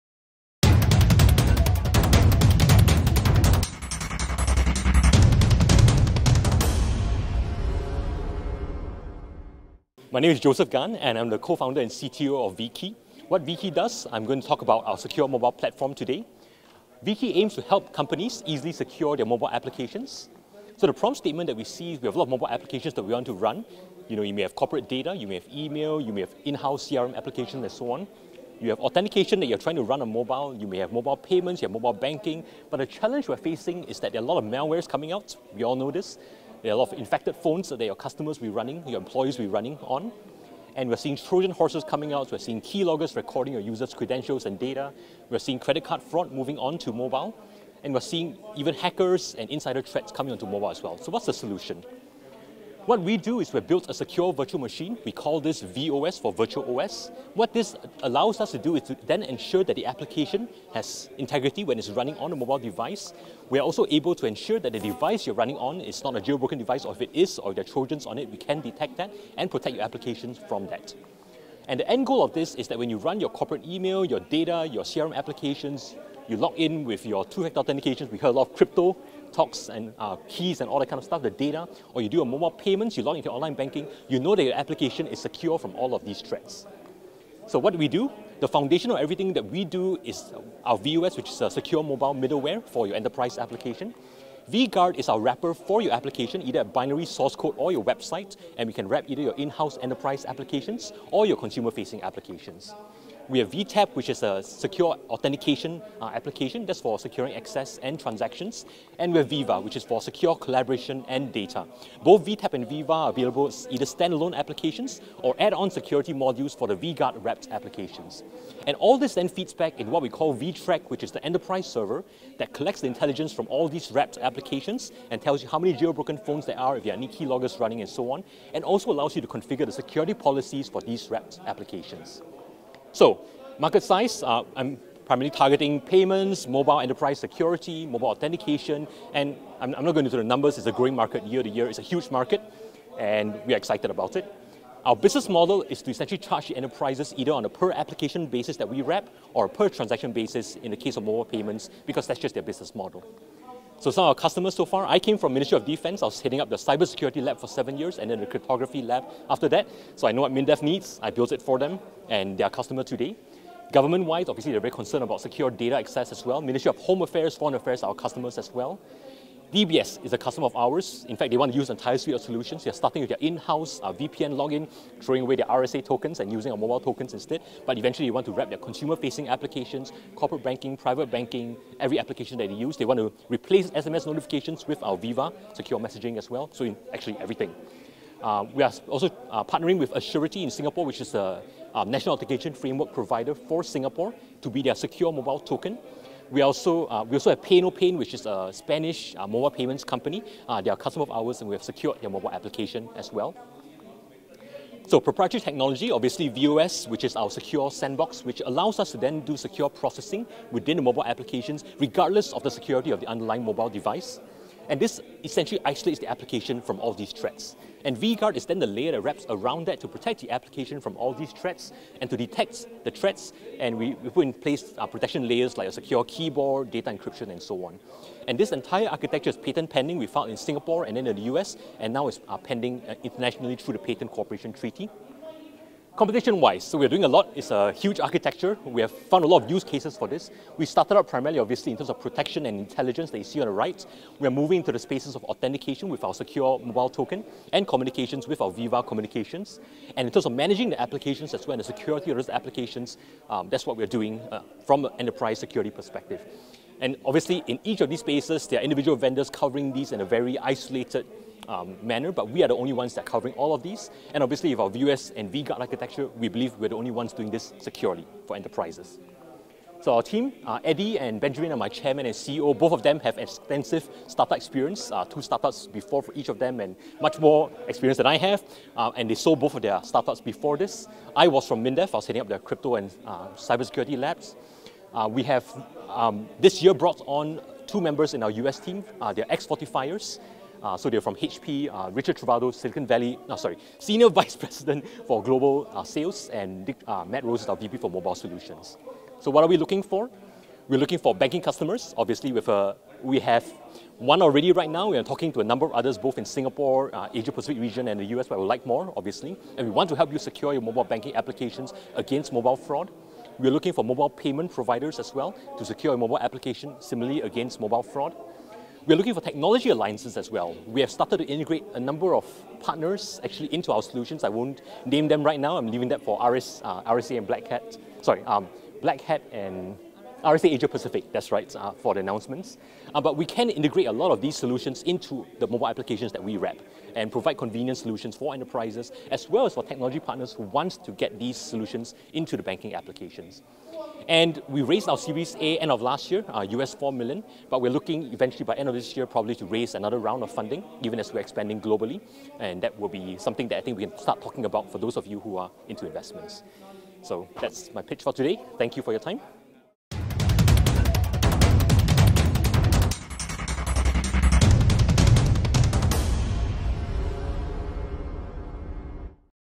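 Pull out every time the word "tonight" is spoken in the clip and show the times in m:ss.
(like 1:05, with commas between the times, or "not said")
not said.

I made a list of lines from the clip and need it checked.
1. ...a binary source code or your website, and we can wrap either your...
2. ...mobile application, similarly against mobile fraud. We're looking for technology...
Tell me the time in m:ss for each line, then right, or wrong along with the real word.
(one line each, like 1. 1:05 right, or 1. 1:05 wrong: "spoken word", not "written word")
1. 1:36 right
2. 5:15 right.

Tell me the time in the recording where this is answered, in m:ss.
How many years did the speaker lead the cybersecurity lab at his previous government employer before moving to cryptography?
2:37.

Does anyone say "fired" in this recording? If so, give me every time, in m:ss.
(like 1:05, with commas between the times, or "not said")
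not said.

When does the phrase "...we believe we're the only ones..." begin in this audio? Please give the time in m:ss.
4:26.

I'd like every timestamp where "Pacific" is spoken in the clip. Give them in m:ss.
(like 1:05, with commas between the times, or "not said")
5:07, 5:30.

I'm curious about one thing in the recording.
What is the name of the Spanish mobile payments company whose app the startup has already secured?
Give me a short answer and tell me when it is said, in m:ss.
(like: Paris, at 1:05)
PayNoPain, at 3:17.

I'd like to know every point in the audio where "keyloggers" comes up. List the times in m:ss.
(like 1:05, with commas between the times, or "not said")
0:42, 2:07.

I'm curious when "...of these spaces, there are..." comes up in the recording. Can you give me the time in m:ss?
4:17.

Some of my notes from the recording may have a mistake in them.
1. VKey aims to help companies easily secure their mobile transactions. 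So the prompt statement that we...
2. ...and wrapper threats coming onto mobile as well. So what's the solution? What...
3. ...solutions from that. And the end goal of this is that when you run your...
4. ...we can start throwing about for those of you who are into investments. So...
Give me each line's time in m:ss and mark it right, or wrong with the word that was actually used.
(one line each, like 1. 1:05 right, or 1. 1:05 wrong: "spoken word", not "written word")
1. 0:17 wrong: "applications", not "transactions"
2. 0:49 wrong: "insider", not "wrapper"
3. 1:09 wrong: "applications", not "solutions"
4. 5:53 wrong: "talking", not "throwing".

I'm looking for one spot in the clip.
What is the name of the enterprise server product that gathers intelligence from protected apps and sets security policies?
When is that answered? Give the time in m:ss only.
2:00.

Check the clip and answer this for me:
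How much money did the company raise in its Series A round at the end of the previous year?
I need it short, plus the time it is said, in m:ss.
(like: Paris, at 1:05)
US$4 million, at 5:46.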